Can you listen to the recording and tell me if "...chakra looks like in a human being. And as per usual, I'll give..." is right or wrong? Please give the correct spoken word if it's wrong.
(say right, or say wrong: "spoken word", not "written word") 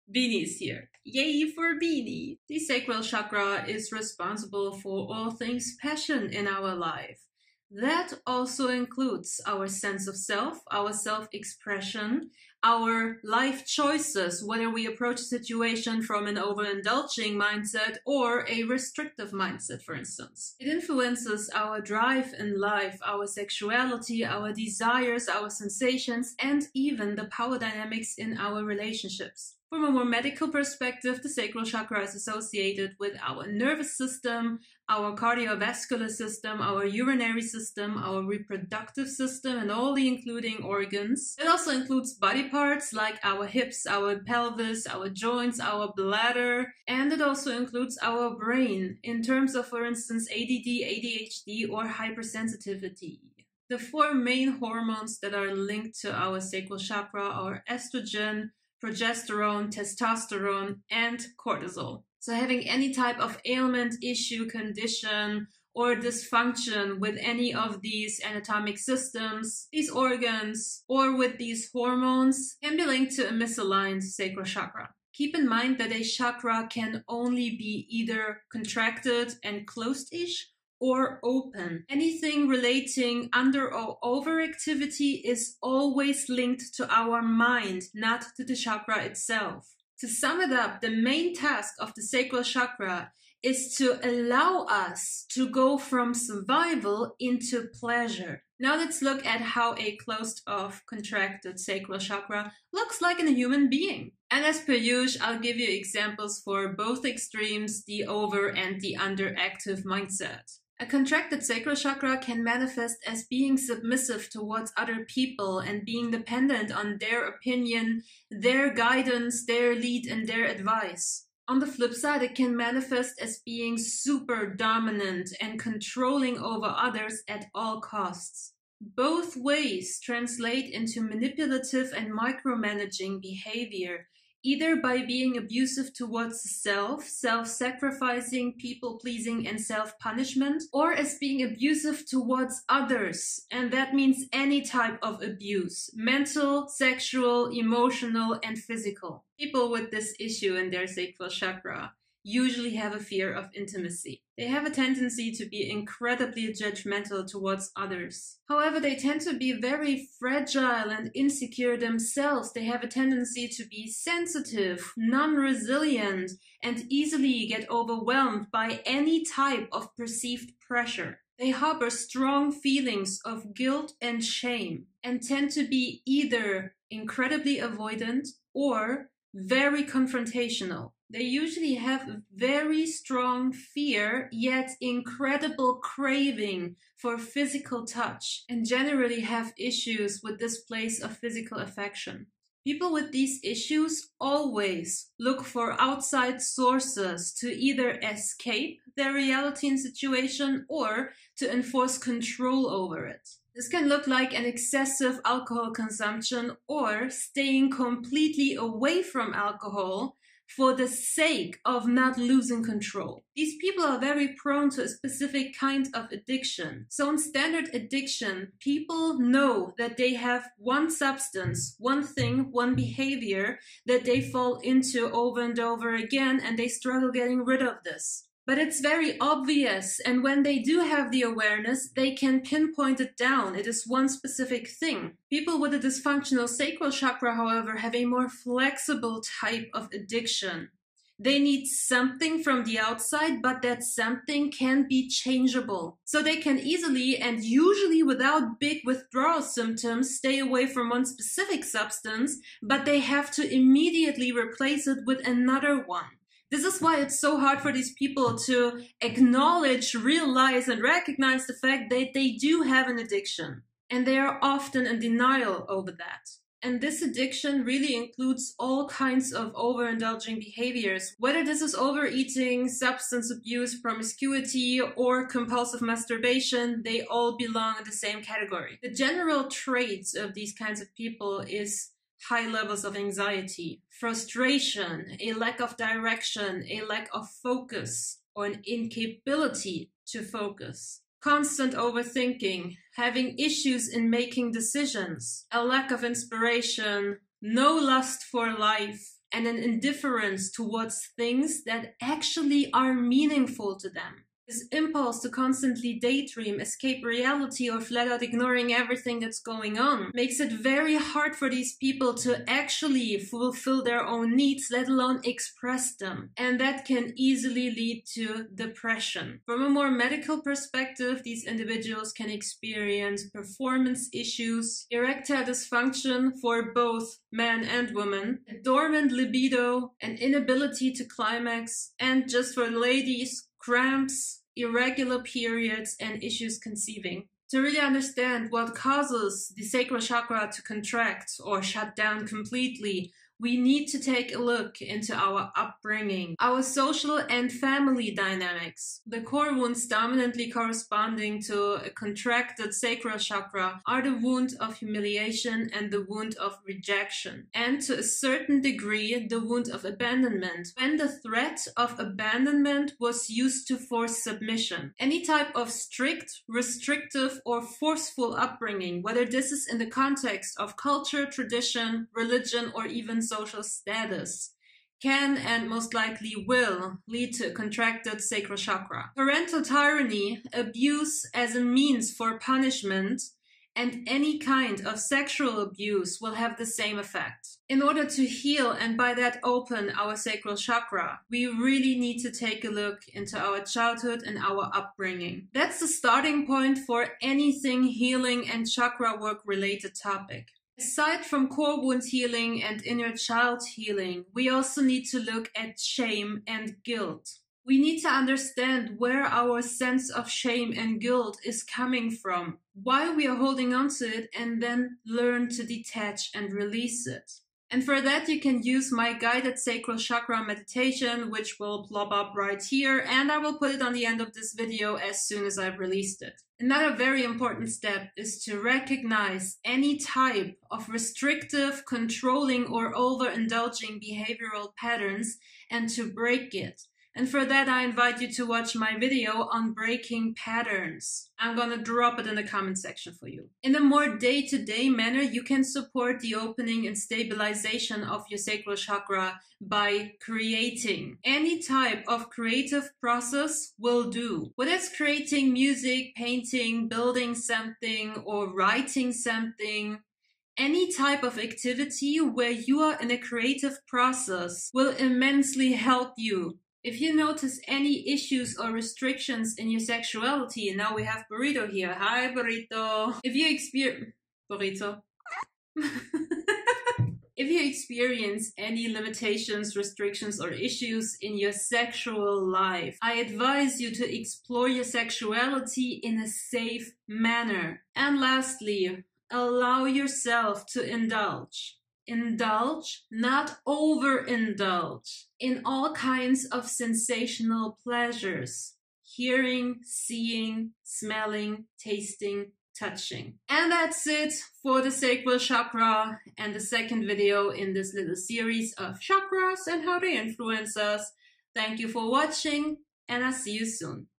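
right.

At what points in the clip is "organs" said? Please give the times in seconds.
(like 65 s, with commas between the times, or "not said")
40 s, 69 s.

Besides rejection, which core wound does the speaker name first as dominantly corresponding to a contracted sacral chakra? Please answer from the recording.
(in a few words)
Humiliation.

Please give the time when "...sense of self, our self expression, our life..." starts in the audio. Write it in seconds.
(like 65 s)
9 s.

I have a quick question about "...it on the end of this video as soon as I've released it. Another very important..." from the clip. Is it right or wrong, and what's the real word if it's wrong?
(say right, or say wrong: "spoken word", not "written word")
right.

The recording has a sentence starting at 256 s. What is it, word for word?
This is why it's so hard for these people to acknowledge, realize, and recognize the fact that they do have an addiction.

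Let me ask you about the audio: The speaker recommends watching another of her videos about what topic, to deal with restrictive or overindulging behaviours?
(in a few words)
Breaking patterns.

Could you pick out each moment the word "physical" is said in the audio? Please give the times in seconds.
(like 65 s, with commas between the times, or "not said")
148 s, 187 s, 191 s.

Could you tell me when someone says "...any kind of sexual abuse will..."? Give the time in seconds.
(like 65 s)
384 s.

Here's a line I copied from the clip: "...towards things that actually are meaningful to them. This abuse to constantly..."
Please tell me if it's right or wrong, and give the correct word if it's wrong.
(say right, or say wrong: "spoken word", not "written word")
wrong: "impulse", not "abuse".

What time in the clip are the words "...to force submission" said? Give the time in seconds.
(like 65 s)
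363 s.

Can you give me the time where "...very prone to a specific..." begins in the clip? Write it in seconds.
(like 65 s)
213 s.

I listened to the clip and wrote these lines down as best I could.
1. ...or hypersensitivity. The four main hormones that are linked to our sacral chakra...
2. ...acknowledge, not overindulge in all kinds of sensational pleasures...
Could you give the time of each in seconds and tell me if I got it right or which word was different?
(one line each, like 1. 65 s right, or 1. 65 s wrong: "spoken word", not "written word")
1. 51 s right
2. 492 s wrong: "indulge", not "acknowledge".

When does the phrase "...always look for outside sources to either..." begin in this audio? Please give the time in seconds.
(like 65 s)
194 s.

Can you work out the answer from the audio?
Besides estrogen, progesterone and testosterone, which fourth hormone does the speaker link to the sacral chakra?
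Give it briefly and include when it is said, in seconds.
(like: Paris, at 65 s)
Cortisol, at 61 s.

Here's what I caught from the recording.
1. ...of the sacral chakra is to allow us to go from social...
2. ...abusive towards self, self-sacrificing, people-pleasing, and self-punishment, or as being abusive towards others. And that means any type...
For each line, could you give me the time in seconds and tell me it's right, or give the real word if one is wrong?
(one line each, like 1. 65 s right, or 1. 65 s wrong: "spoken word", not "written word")
1. 91 s wrong: "survival", not "social"
2. 135 s right.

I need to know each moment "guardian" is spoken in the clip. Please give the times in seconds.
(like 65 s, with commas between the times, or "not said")
not said.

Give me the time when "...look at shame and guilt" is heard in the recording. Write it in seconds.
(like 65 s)
405 s.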